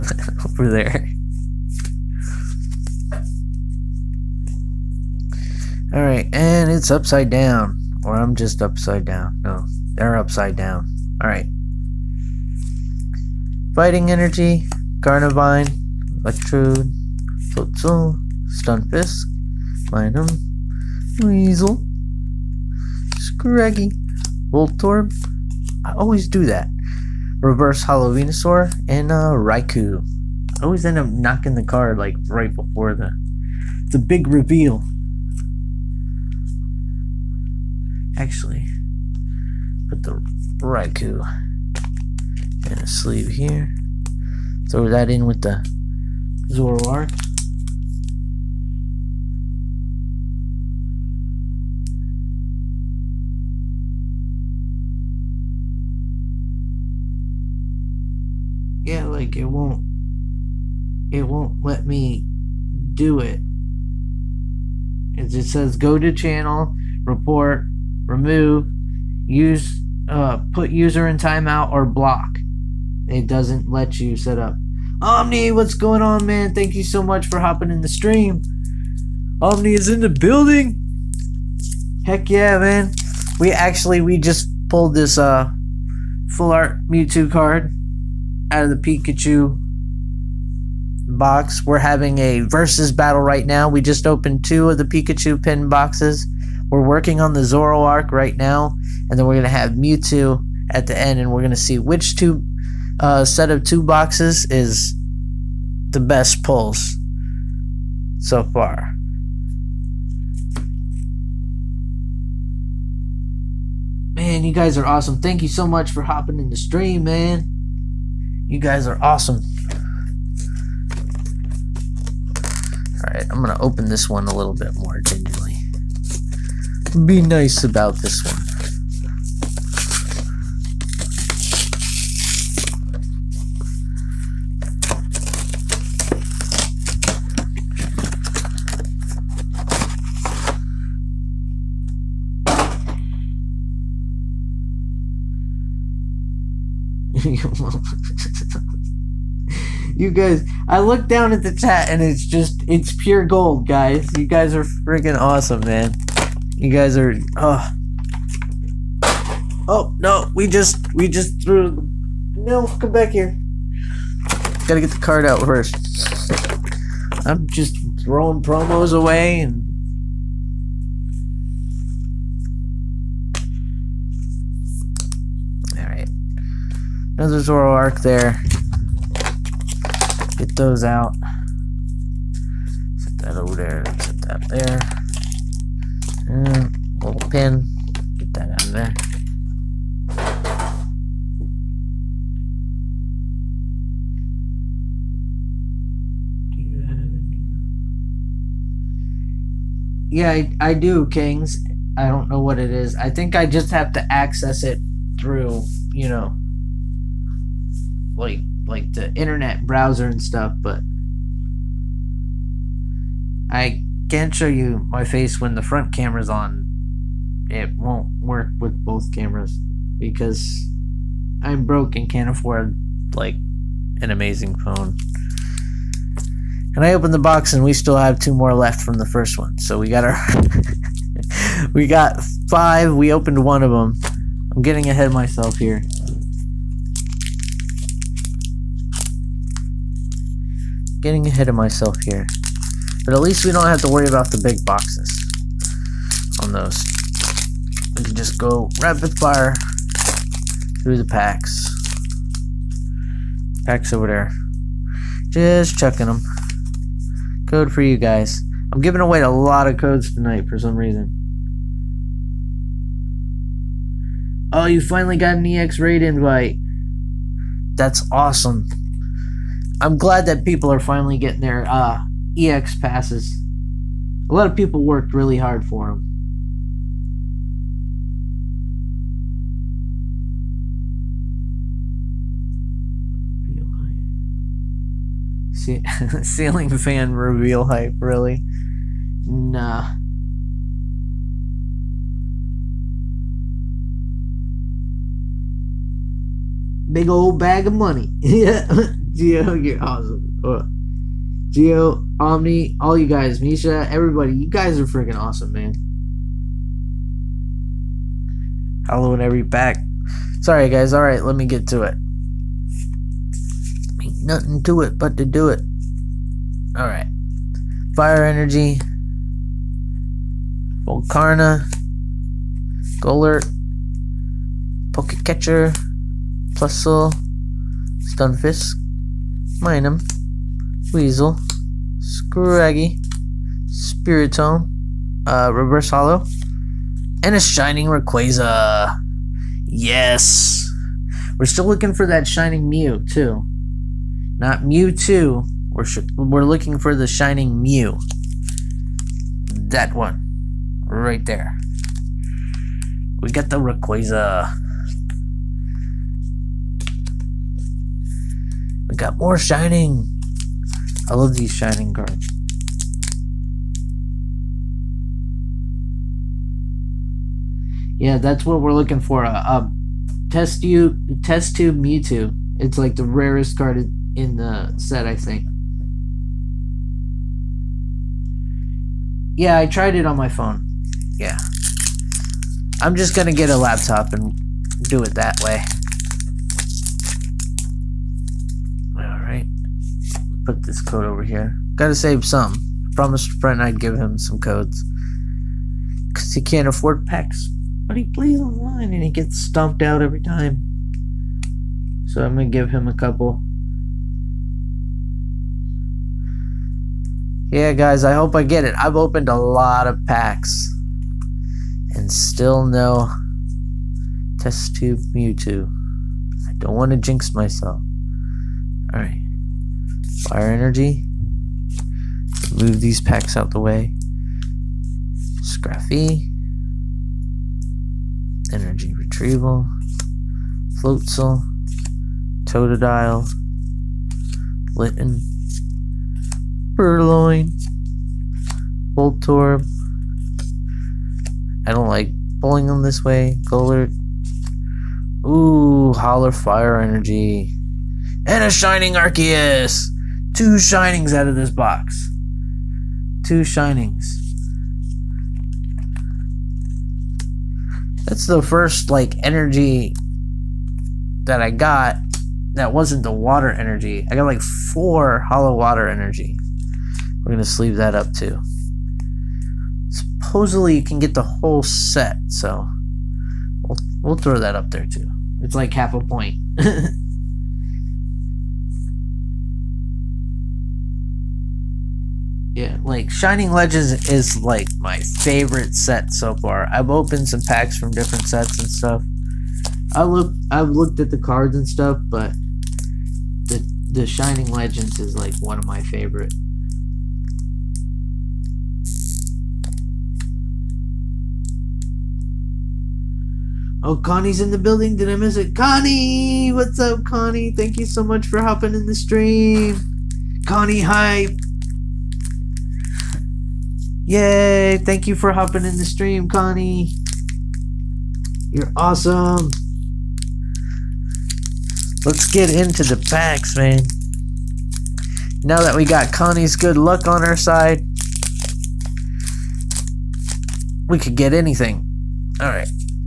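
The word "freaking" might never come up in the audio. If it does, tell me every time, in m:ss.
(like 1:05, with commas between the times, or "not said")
2:34, 5:04.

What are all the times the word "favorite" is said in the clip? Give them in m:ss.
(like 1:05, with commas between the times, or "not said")
8:04, 8:15.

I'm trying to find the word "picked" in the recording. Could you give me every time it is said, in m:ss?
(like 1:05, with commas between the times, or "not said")
not said.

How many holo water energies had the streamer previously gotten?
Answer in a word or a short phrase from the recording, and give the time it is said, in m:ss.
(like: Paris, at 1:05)
4, at 7:44.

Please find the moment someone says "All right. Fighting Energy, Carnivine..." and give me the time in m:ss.
0:11.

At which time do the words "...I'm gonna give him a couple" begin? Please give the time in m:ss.
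6:42.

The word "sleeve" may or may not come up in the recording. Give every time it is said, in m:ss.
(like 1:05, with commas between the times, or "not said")
0:42, 7:47.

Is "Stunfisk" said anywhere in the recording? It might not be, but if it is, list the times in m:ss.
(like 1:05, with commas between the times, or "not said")
0:18, 5:27.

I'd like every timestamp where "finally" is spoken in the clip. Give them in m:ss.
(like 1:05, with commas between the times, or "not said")
4:24, 4:30.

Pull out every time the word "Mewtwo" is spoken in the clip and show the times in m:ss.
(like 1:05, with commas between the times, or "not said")
1:26, 1:39, 5:44, 6:11, 6:55.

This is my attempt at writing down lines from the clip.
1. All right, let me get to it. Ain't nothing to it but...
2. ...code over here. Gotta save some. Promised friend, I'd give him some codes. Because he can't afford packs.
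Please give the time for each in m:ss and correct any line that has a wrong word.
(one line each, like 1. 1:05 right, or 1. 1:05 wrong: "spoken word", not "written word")
1. 5:10 right
2. 6:30 right.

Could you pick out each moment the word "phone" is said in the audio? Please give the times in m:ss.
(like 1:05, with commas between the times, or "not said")
3:44, 6:20.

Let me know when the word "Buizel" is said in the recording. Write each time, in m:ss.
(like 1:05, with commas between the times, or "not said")
0:21, 5:30.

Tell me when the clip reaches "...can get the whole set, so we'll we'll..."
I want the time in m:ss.
7:50.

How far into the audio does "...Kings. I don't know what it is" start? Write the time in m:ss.
3:21.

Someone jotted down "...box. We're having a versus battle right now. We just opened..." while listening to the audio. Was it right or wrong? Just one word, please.
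right.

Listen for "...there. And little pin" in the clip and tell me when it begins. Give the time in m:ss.
3:04.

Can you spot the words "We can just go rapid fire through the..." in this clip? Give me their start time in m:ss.
4:07.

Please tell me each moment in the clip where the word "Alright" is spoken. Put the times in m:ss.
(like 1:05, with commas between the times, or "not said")
6:28, 6:58, 8:52.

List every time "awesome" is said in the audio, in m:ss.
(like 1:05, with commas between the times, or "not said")
1:54, 1:59, 2:35, 4:28, 4:59, 5:05, 8:38.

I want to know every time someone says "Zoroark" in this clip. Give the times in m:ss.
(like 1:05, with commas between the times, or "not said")
0:46, 1:37, 2:57.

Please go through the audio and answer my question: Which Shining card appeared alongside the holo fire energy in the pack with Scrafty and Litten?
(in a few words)
Shining Arceus.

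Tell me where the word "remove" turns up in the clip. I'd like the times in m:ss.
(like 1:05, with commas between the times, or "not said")
1:08.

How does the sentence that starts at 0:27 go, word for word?
Reverse Holo Venusaur and uh, Raikou.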